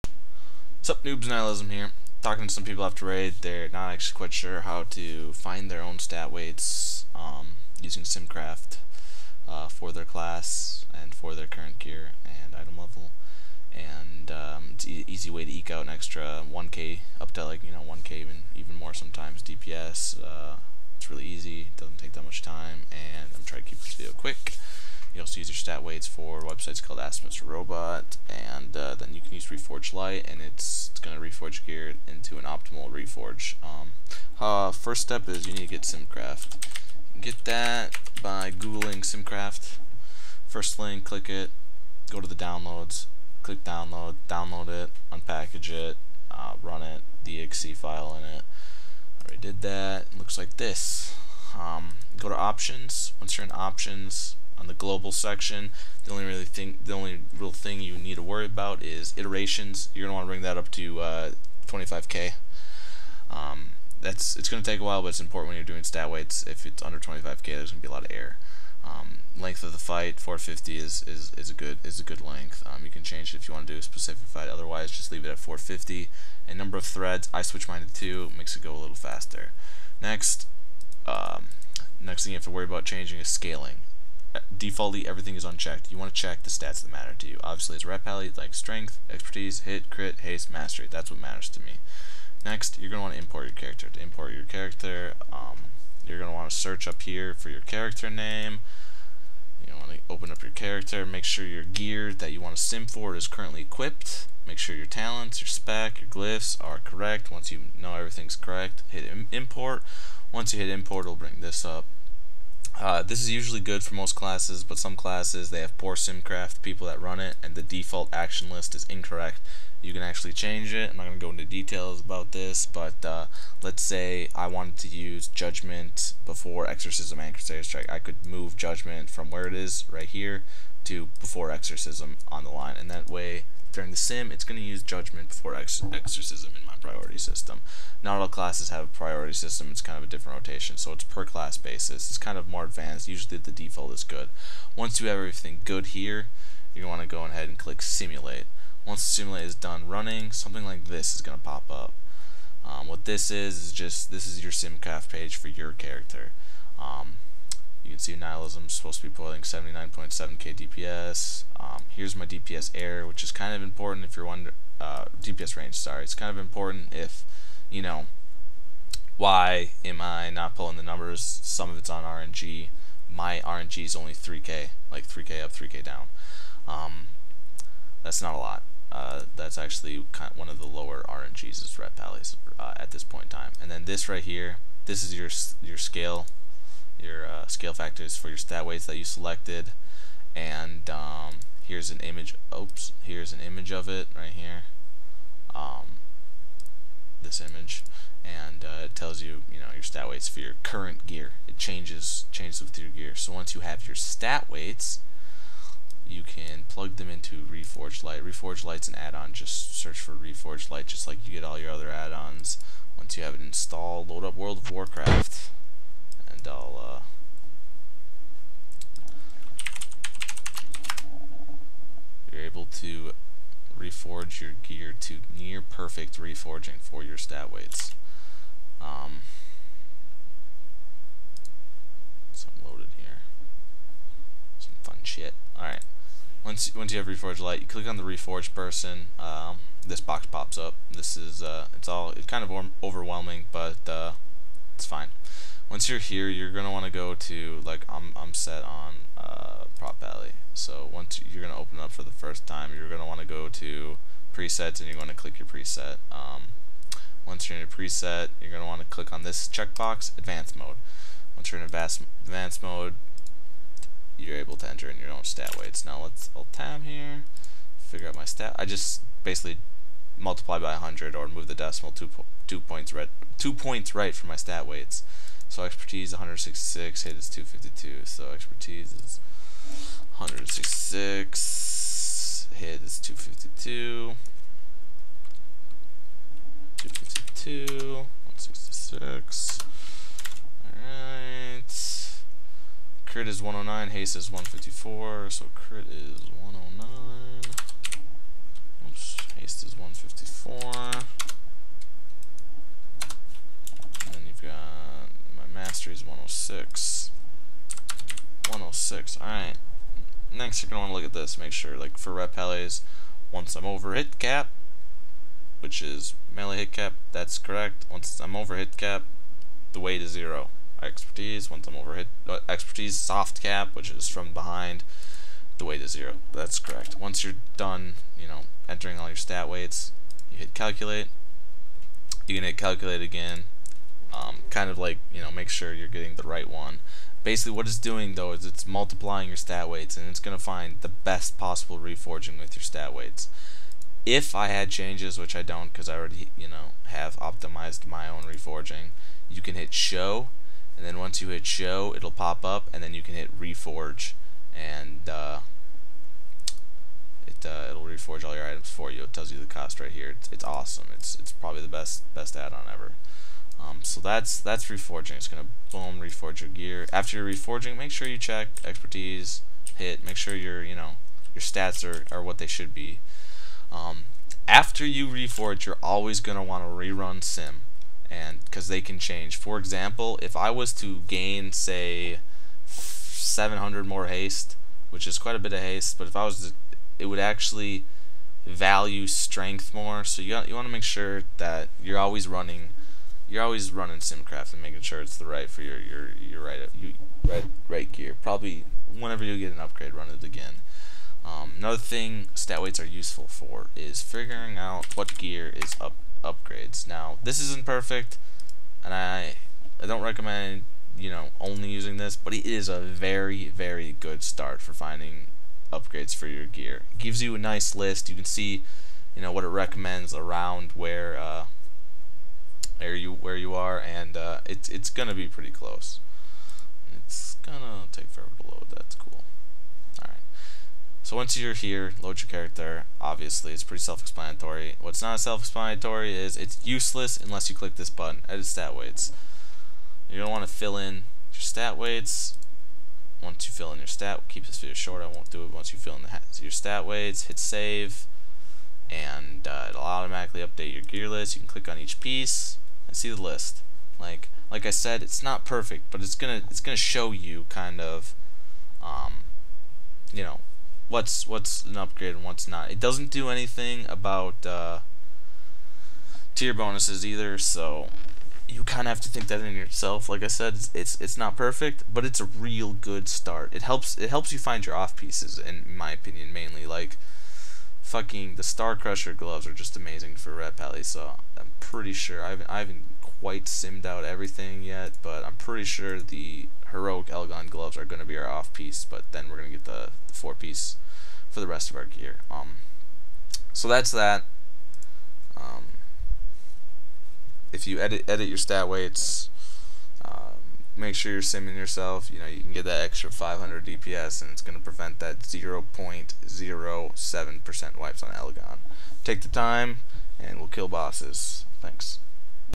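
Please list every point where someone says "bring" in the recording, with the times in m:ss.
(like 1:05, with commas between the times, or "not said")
1:00, 1:51.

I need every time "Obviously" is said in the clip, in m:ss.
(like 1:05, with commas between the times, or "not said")
1:27, 7:12.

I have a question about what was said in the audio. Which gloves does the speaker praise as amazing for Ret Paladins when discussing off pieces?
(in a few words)
Star Crusher gloves.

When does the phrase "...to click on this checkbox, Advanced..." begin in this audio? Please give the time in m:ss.
4:18.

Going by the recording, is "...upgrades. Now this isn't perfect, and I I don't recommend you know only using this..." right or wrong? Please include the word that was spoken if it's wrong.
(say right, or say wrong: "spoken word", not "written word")
right.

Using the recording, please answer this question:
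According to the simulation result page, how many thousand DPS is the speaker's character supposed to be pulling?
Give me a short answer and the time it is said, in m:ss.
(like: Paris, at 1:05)
79.7 kdps, at 2:39.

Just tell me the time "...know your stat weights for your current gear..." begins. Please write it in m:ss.
3:19.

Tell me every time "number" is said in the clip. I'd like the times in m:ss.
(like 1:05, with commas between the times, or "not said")
1:16, 2:50.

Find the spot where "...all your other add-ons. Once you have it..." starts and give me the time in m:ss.
3:31.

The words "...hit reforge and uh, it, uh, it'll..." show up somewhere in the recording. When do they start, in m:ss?
5:53.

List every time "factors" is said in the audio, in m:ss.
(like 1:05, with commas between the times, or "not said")
3:07.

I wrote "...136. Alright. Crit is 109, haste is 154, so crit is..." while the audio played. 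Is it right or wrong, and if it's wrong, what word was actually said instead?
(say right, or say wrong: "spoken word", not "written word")
wrong: "166", not "136".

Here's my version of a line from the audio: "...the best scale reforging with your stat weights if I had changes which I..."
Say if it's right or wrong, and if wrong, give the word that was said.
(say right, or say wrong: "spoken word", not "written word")
wrong: "possible", not "scale".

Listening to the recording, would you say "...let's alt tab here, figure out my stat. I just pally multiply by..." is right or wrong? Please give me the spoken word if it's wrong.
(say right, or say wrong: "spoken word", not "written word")
wrong: "basically", not "pally".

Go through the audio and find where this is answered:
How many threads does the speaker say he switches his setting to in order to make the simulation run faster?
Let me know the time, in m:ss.
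1:17.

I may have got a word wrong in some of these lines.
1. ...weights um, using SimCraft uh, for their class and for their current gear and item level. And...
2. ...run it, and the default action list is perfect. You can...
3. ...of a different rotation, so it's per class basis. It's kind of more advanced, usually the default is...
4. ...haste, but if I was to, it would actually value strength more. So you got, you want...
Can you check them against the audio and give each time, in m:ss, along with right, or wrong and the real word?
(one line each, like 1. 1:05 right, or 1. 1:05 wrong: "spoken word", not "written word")
1. 0:06 right
2. 1:57 wrong: "incorrect", not "perfect"
3. 2:19 right
4. 6:25 right.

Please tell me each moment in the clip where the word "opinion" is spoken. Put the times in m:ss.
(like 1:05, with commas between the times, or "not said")
7:55.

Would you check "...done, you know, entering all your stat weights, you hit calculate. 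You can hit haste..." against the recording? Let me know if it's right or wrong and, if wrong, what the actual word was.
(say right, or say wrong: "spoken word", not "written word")
wrong: "calculate", not "haste".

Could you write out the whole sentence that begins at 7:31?
You can click on each piece, and see the list.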